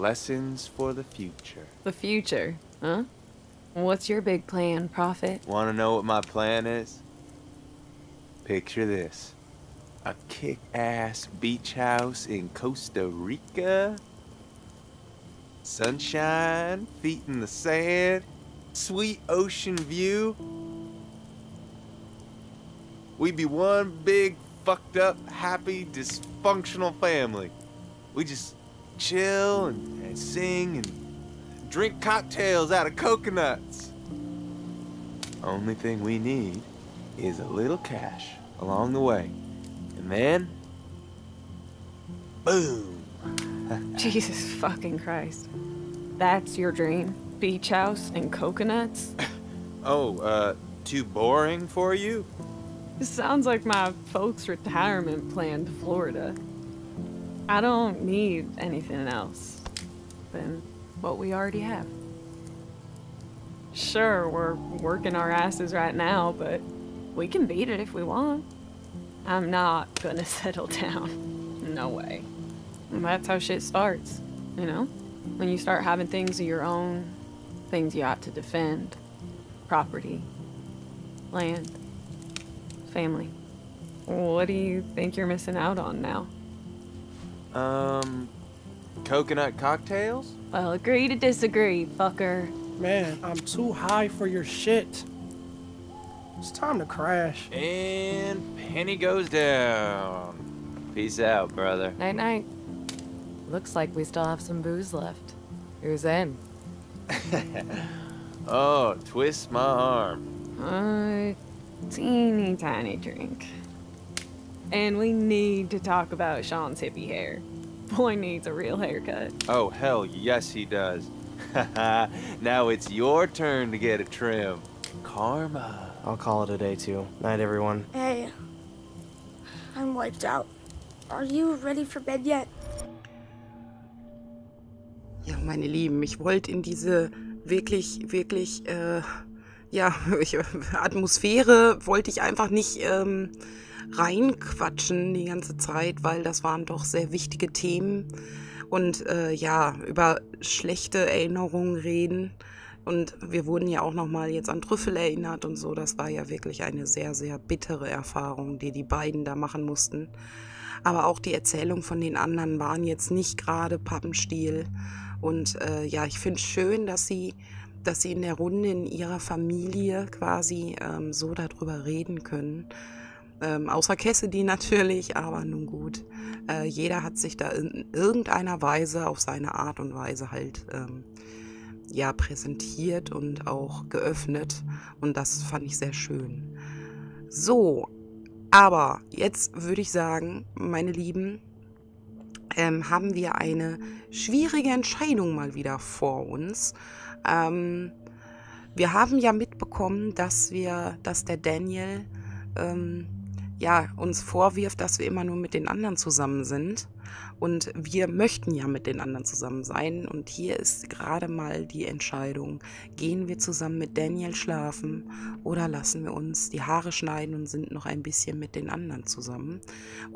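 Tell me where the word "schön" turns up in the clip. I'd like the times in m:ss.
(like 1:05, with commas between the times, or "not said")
2:46, 3:05.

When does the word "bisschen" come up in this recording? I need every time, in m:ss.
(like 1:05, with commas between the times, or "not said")
3:38.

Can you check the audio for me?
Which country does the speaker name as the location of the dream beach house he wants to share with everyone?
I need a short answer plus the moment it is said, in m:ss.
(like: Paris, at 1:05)
Costa Rica, at 0:12.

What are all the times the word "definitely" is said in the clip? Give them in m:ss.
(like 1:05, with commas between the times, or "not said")
not said.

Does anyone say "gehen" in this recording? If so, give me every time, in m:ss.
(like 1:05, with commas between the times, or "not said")
3:32.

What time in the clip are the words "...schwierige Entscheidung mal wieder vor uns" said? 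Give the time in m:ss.
3:14.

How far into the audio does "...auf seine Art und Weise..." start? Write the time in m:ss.
2:59.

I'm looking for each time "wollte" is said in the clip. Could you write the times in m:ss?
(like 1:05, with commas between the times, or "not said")
2:16, 2:21.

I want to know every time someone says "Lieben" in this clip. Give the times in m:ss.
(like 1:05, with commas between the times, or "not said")
2:15, 3:10.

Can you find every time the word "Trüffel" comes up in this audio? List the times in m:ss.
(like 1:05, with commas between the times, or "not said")
2:34.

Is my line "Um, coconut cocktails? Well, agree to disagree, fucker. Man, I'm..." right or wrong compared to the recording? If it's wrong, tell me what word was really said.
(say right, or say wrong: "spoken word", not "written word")
right.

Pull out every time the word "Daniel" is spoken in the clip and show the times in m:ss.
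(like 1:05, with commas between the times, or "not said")
3:21, 3:33.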